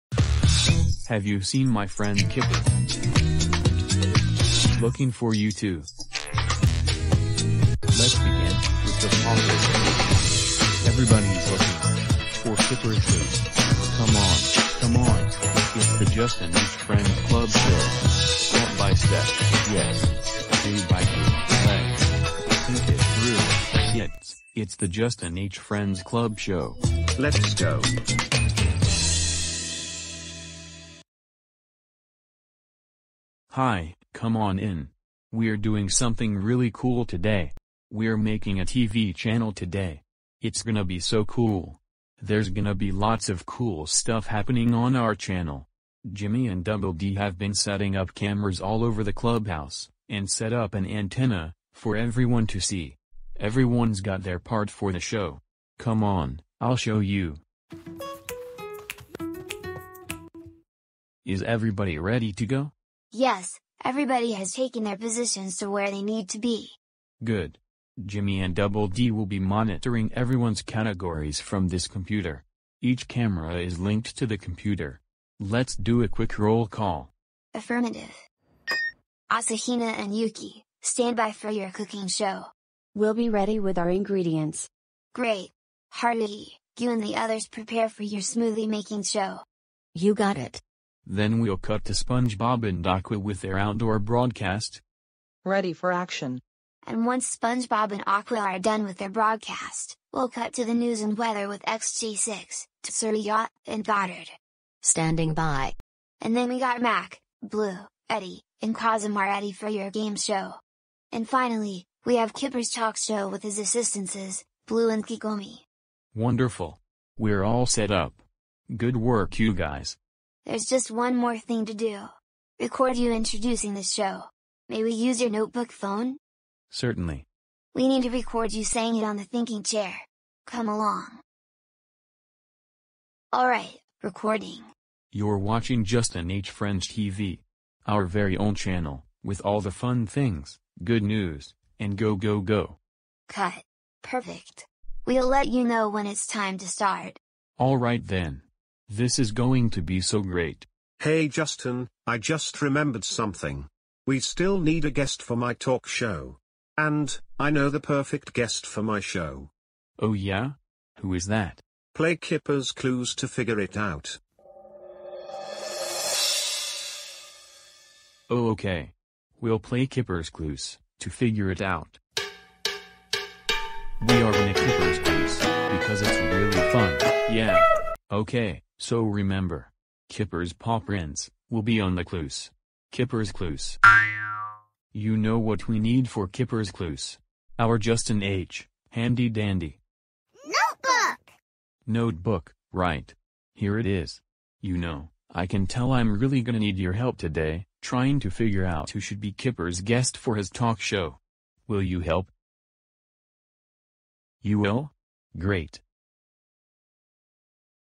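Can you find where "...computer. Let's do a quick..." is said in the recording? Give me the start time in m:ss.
1:14.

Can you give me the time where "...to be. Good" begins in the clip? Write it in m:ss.
1:06.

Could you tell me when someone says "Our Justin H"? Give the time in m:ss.
3:07.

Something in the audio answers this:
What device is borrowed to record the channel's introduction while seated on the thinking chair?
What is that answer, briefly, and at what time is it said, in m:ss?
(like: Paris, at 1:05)
notebook phone, at 2:05.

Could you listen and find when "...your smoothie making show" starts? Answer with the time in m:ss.
1:28.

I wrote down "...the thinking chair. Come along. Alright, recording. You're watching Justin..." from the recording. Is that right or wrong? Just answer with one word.
right.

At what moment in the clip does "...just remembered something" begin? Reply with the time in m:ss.
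2:32.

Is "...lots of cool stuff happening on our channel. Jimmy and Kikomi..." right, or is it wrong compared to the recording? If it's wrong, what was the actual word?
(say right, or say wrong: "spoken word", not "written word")
wrong: "Double", not "Kikomi".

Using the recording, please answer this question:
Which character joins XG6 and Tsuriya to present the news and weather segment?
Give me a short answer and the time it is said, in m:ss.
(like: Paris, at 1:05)
Goddard, at 1:43.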